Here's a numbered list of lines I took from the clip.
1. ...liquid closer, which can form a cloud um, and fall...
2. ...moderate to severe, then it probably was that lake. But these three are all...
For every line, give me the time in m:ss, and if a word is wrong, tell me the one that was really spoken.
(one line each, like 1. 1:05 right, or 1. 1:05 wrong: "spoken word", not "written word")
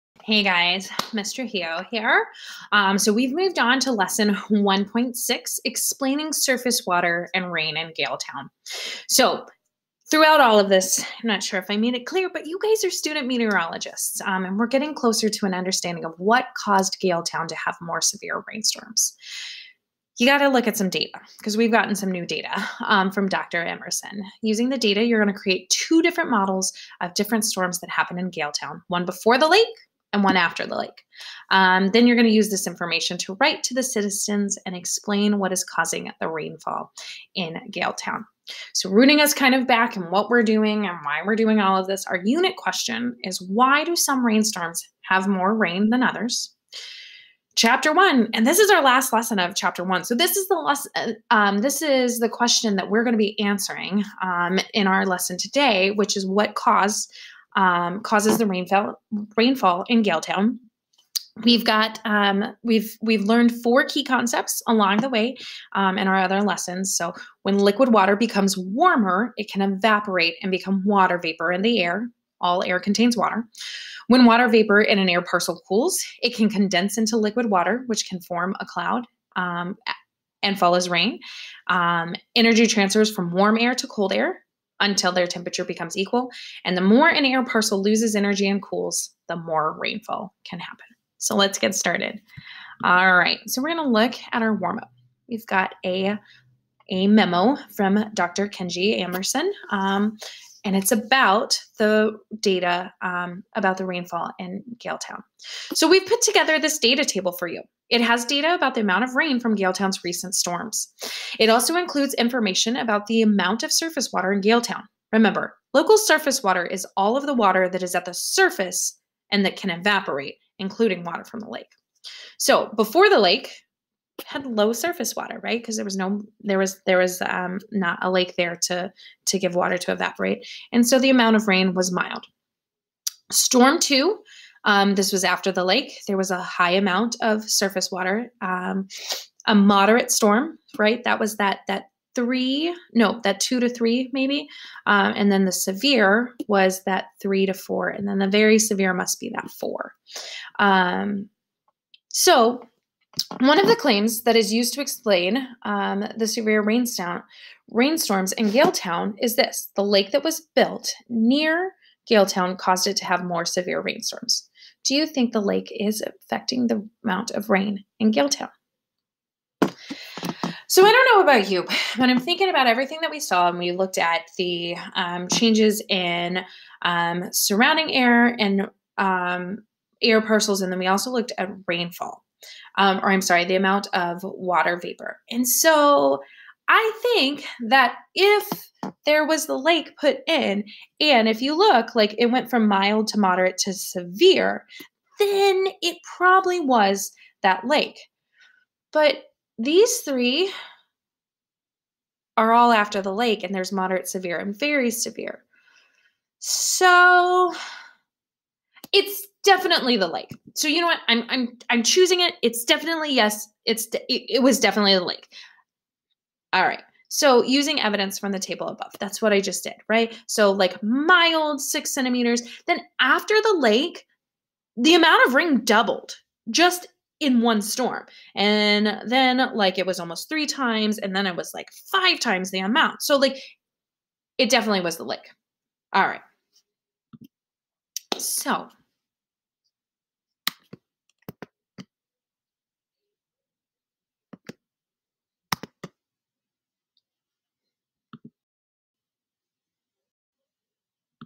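1. 1:17 wrong: "water", not "closer"
2. 3:13 right.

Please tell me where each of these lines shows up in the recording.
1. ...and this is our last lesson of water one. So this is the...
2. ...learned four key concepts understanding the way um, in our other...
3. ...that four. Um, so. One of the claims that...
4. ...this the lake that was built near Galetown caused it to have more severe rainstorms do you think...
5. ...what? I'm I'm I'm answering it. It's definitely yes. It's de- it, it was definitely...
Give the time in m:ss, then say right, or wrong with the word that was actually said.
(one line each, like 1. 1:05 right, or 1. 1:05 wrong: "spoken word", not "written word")
1. 0:48 wrong: "chapter", not "water"
2. 1:03 wrong: "along", not "understanding"
3. 2:29 right
4. 2:39 right
5. 3:30 wrong: "choosing", not "answering".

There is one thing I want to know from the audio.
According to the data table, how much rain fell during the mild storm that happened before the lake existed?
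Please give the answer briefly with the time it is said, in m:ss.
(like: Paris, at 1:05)
6 centimeters, at 3:41.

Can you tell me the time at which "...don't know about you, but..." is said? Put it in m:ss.
2:50.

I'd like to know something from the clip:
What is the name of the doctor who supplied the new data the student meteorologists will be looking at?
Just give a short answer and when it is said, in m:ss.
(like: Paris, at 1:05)
Dr. Emerson, at 0:23.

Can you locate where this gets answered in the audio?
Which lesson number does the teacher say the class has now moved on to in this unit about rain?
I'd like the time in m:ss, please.
0:03.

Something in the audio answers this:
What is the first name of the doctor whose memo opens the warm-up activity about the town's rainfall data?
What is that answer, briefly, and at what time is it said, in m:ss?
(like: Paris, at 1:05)
Kenji, at 1:38.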